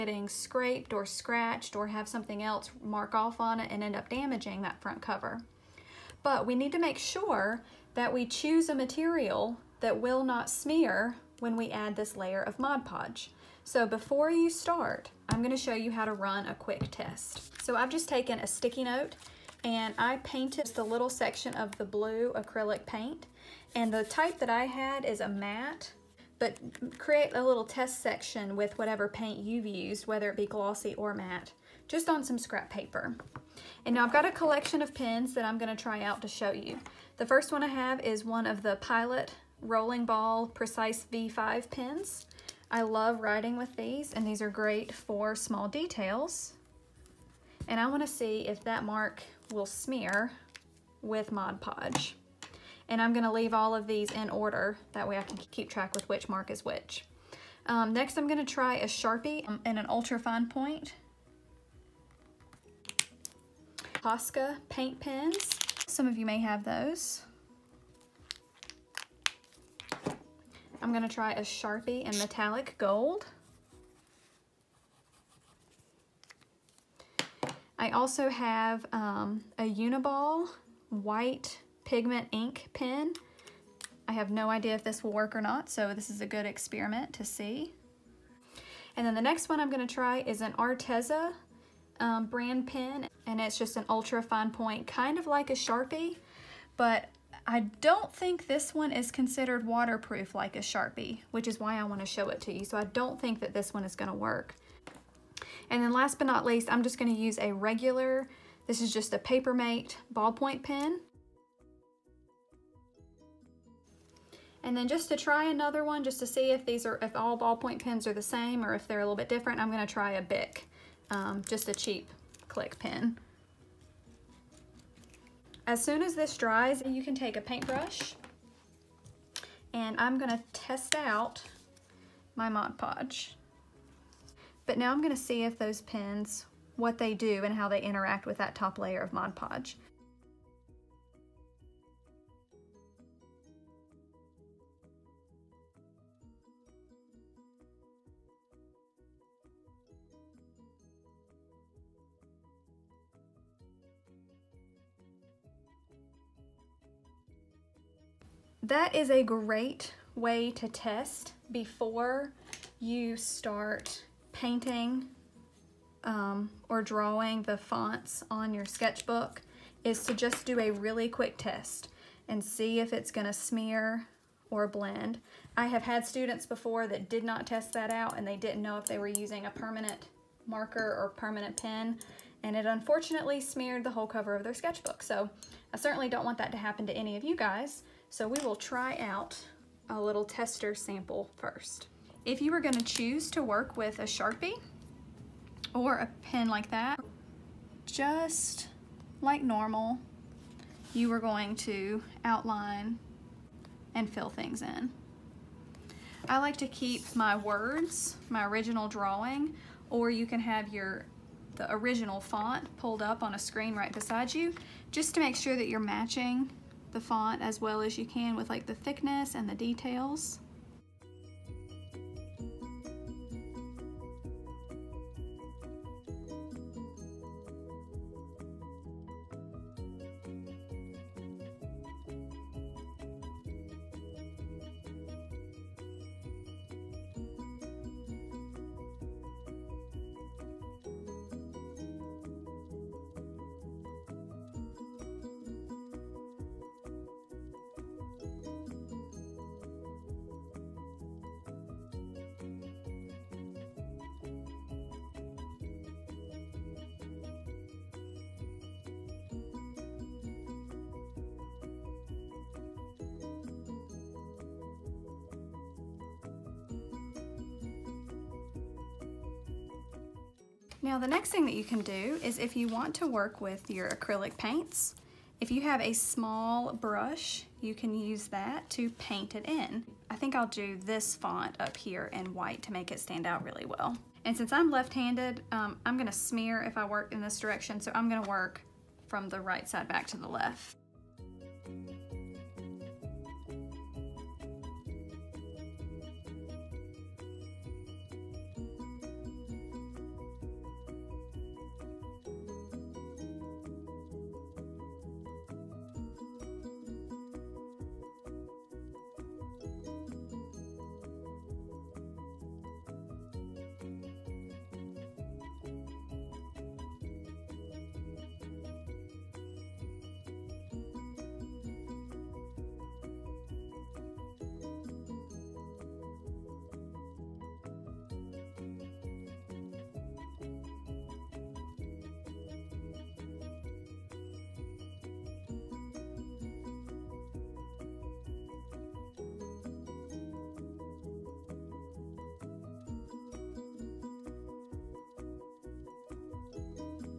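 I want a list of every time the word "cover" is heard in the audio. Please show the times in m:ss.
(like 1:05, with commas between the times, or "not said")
0:05, 3:04.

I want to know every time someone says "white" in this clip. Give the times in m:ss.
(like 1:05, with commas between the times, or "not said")
1:20, 4:42.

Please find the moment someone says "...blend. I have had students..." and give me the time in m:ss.
2:54.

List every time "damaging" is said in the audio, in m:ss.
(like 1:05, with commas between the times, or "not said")
0:04.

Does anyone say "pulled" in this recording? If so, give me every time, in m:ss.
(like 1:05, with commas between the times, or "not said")
3:32.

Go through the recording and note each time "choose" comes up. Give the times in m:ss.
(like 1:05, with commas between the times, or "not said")
0:08, 3:12.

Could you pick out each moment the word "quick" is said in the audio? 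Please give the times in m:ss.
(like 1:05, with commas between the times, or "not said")
0:16, 2:51.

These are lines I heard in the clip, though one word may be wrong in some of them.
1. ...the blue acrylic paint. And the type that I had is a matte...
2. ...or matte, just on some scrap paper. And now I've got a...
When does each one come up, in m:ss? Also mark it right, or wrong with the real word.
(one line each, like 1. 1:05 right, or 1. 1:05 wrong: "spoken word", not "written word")
1. 0:21 right
2. 0:30 right.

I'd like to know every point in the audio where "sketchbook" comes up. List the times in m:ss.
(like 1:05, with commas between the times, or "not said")
2:48, 3:04.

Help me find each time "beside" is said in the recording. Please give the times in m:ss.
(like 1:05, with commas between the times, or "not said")
3:33.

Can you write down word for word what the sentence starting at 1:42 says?
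So I don't think that this one is gonna work.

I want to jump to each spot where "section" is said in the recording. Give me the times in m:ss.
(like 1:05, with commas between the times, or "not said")
0:21, 0:28.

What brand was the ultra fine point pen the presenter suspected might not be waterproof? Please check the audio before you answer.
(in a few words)
Arteza.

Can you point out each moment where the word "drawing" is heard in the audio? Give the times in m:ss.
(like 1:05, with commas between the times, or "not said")
2:46, 3:28.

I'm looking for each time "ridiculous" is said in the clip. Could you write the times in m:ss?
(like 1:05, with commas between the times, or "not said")
not said.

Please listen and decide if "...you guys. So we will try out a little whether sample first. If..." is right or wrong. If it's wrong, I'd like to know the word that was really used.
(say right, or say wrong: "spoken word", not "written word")
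wrong: "tester", not "whether".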